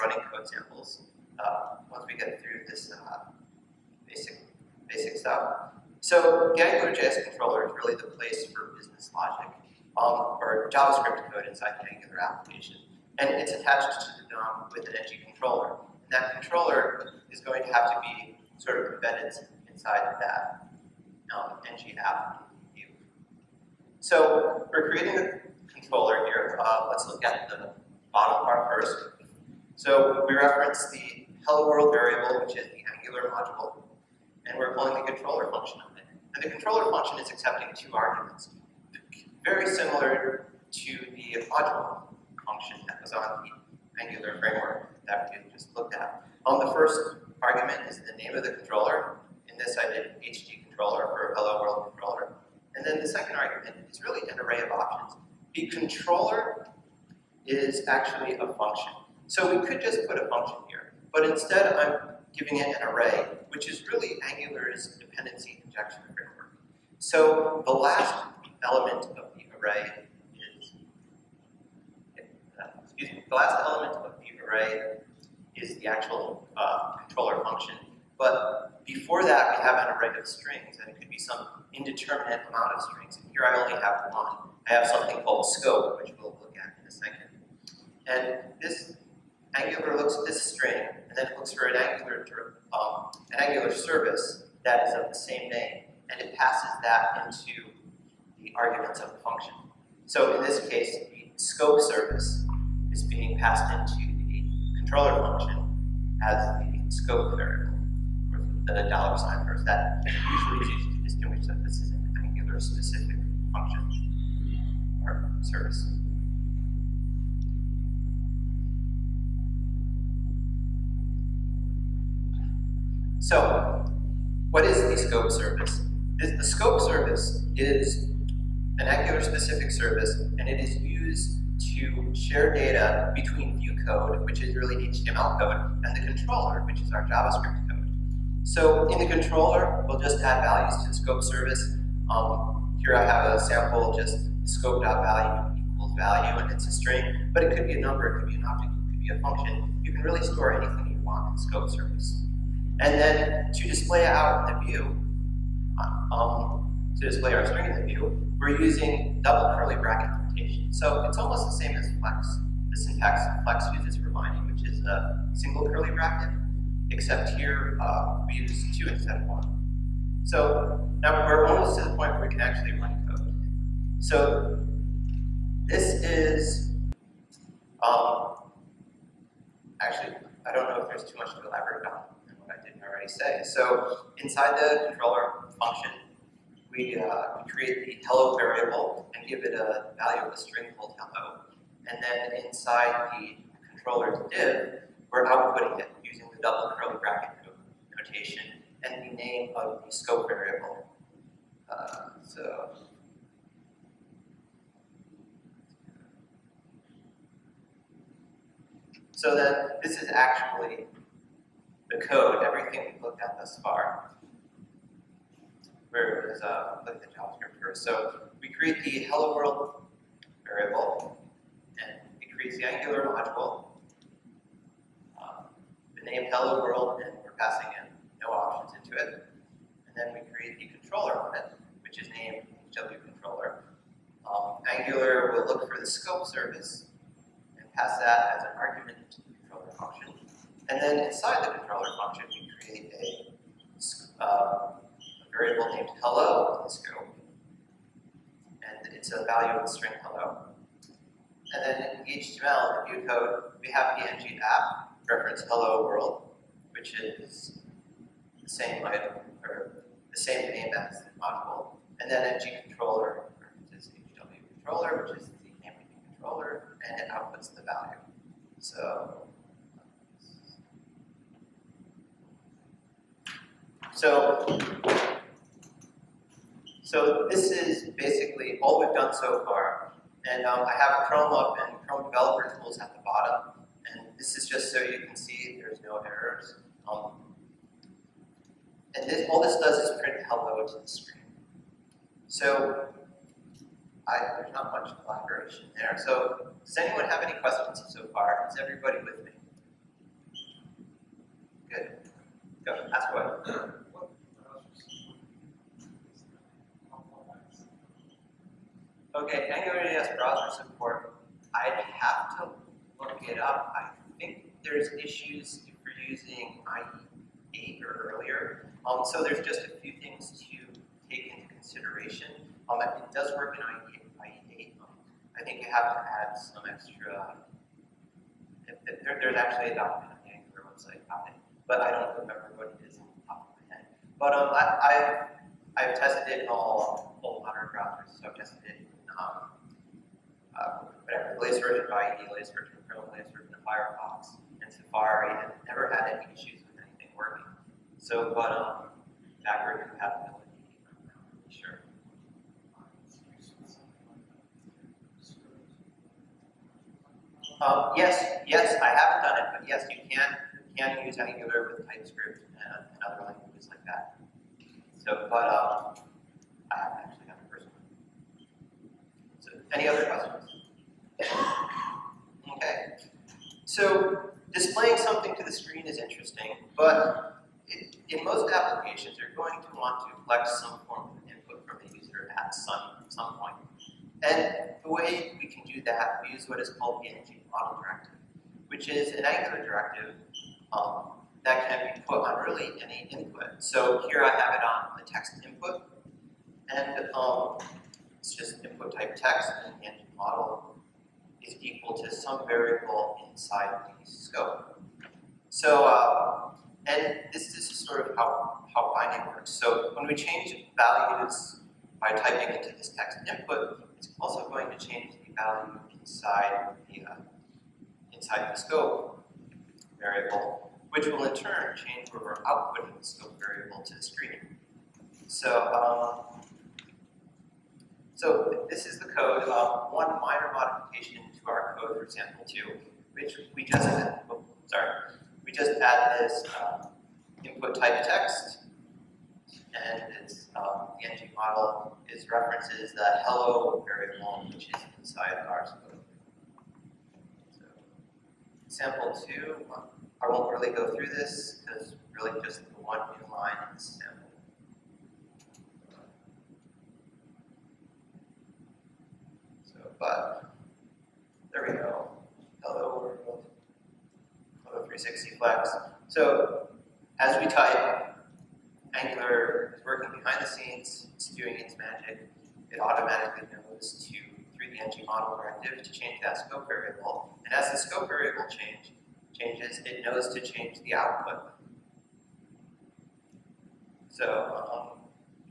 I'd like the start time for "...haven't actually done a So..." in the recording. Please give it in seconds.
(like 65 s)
366 s.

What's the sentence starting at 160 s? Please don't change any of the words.
So it's almost the same as flex.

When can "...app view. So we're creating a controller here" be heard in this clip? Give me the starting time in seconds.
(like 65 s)
21 s.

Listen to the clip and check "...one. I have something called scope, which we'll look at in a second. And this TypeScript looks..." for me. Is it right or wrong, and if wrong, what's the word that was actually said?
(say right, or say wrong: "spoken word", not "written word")
wrong: "Angular", not "TypeScript".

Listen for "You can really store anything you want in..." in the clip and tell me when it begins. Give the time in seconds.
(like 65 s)
149 s.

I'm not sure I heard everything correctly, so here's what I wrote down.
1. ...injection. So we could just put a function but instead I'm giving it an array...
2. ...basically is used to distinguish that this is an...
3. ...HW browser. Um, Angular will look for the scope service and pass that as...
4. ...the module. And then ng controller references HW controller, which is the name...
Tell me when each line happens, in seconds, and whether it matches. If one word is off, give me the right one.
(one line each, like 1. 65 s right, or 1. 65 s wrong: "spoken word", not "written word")
1. 58 s wrong: "function", not "injection"
2. 110 s wrong: "usually", not "basically"
3. 232 s wrong: "controller", not "browser"
4. 261 s right.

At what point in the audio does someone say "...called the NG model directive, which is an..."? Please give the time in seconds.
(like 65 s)
386 s.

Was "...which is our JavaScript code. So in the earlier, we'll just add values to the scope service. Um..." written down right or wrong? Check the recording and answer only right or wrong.
wrong.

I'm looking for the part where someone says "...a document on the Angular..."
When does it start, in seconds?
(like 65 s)
329 s.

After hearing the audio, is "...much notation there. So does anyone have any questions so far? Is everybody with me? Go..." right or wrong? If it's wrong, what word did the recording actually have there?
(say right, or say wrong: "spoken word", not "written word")
wrong: "collaboration", not "notation".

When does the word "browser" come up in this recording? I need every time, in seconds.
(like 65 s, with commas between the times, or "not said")
310 s, 337 s.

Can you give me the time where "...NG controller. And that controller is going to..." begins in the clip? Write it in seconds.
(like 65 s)
14 s.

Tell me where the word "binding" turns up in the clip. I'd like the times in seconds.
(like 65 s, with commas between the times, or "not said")
164 s, 408 s.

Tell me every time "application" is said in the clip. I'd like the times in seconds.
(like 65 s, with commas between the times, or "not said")
12 s, 378 s.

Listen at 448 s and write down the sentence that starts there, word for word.
Sample 2, um, I won't really go through this because really just the one new line in the sample.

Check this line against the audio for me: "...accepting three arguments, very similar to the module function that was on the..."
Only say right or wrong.
wrong.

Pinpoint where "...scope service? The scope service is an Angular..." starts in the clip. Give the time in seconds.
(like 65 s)
125 s.